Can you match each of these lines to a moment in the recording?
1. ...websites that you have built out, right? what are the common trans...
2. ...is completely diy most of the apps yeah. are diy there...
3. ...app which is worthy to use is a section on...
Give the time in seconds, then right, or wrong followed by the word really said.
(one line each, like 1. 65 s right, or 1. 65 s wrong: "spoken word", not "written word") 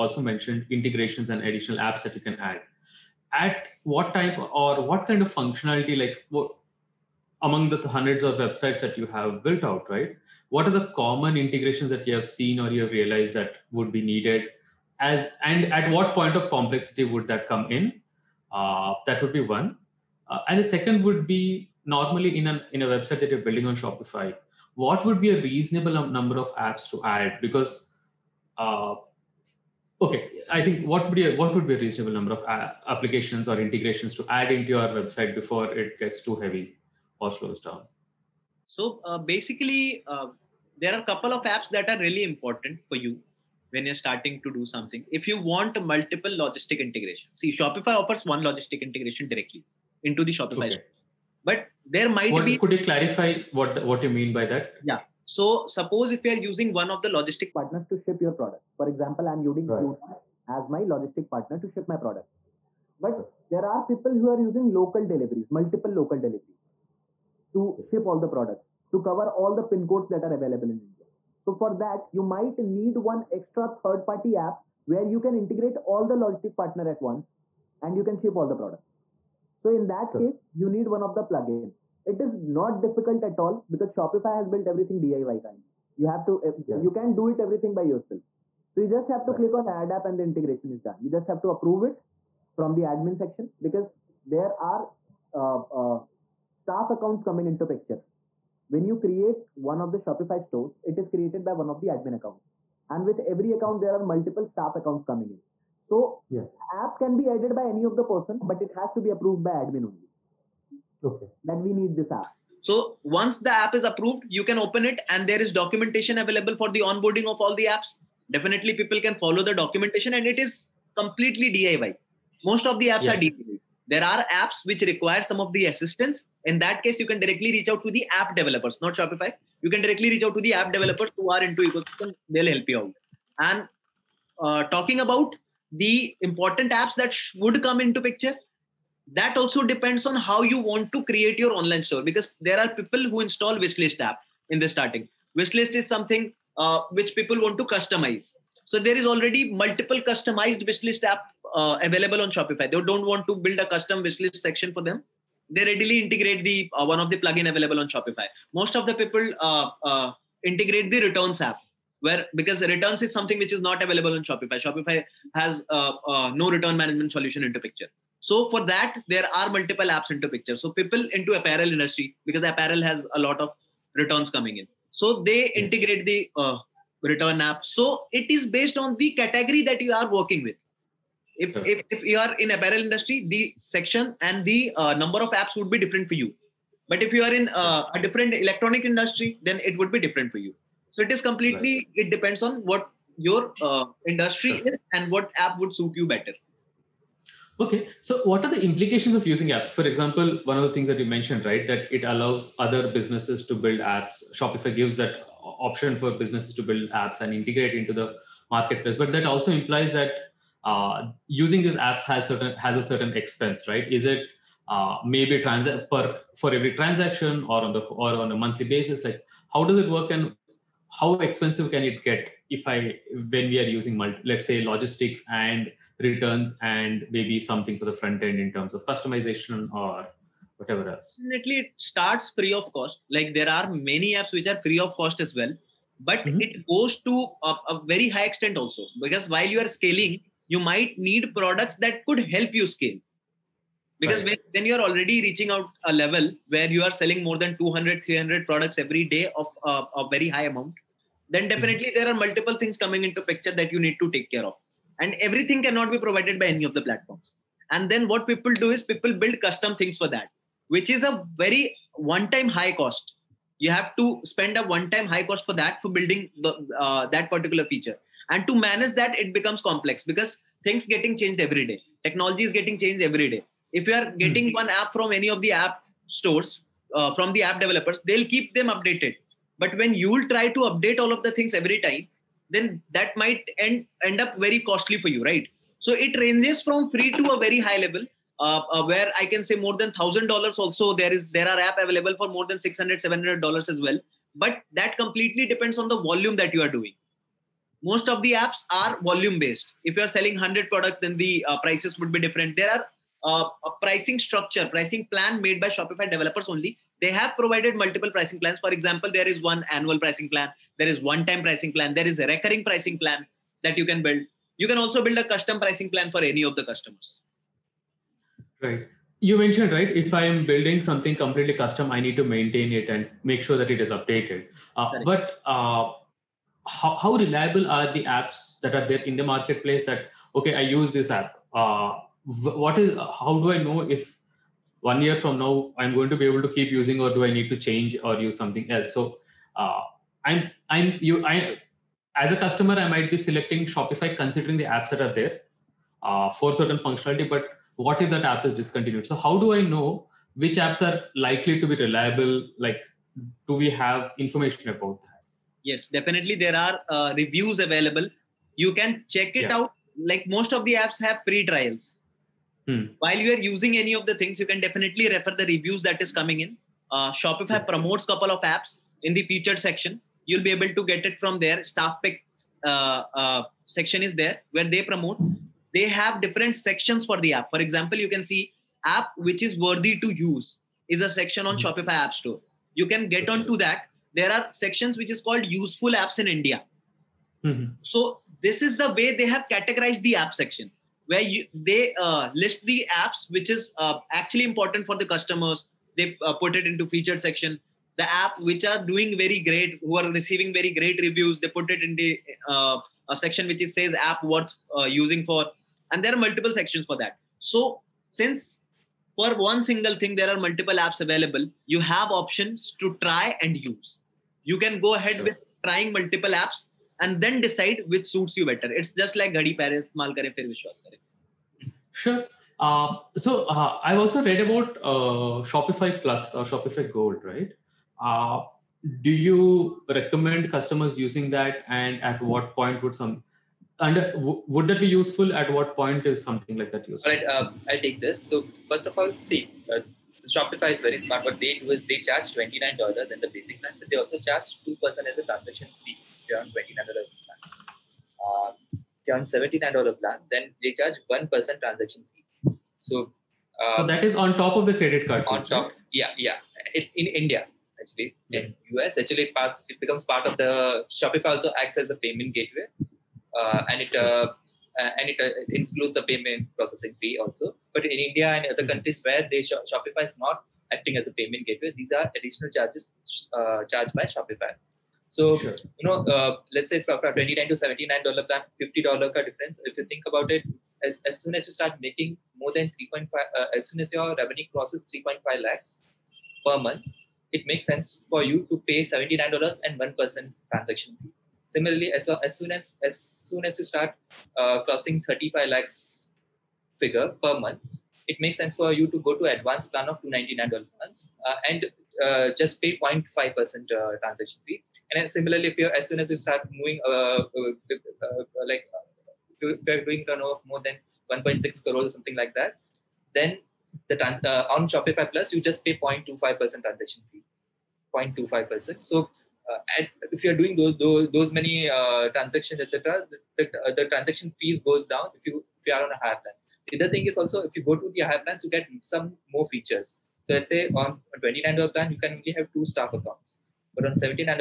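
1. 8 s wrong: "integrations", not "trans"
2. 120 s right
3. 378 s right.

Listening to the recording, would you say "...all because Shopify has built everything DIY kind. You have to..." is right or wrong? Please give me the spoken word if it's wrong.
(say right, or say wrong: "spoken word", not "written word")
right.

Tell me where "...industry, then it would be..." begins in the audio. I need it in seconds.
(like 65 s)
188 s.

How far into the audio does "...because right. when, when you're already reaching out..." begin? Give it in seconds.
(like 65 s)
243 s.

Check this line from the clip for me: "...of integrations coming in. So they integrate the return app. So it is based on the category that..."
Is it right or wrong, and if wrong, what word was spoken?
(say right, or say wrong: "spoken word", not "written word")
wrong: "returns", not "integrations".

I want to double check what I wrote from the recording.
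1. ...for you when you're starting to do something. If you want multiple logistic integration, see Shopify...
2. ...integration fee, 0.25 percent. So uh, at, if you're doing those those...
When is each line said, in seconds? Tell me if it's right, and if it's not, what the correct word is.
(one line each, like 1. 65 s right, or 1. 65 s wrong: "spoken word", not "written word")
1. 42 s right
2. 516 s wrong: "transaction", not "integration".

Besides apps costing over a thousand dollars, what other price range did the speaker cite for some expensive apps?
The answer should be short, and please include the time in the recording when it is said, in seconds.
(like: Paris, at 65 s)
600-700 dollars, at 292 s.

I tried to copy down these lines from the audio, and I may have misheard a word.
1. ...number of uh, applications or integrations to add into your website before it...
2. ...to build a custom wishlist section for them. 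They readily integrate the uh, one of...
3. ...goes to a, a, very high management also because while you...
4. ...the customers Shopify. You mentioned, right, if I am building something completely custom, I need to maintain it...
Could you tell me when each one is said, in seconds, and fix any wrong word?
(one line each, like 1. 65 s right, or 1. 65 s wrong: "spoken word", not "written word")
1. 32 s right
2. 153 s right
3. 236 s wrong: "extent", not "management"
4. 316 s wrong: "Right", not "Shopify".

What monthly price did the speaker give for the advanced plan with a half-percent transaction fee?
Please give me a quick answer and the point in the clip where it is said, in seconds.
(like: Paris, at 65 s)
299 dollars, at 500 s.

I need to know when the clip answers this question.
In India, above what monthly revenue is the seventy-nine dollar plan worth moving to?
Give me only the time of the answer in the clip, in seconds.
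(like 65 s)
484 s.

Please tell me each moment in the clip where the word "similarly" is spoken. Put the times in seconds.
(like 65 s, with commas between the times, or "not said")
491 s, 505 s.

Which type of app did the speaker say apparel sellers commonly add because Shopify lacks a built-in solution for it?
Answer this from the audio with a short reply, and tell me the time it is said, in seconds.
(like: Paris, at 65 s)
Returns app, at 161 s.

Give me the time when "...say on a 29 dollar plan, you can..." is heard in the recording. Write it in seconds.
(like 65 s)
530 s.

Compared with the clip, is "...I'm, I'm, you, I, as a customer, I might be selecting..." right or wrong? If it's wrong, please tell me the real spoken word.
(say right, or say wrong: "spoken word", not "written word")
right.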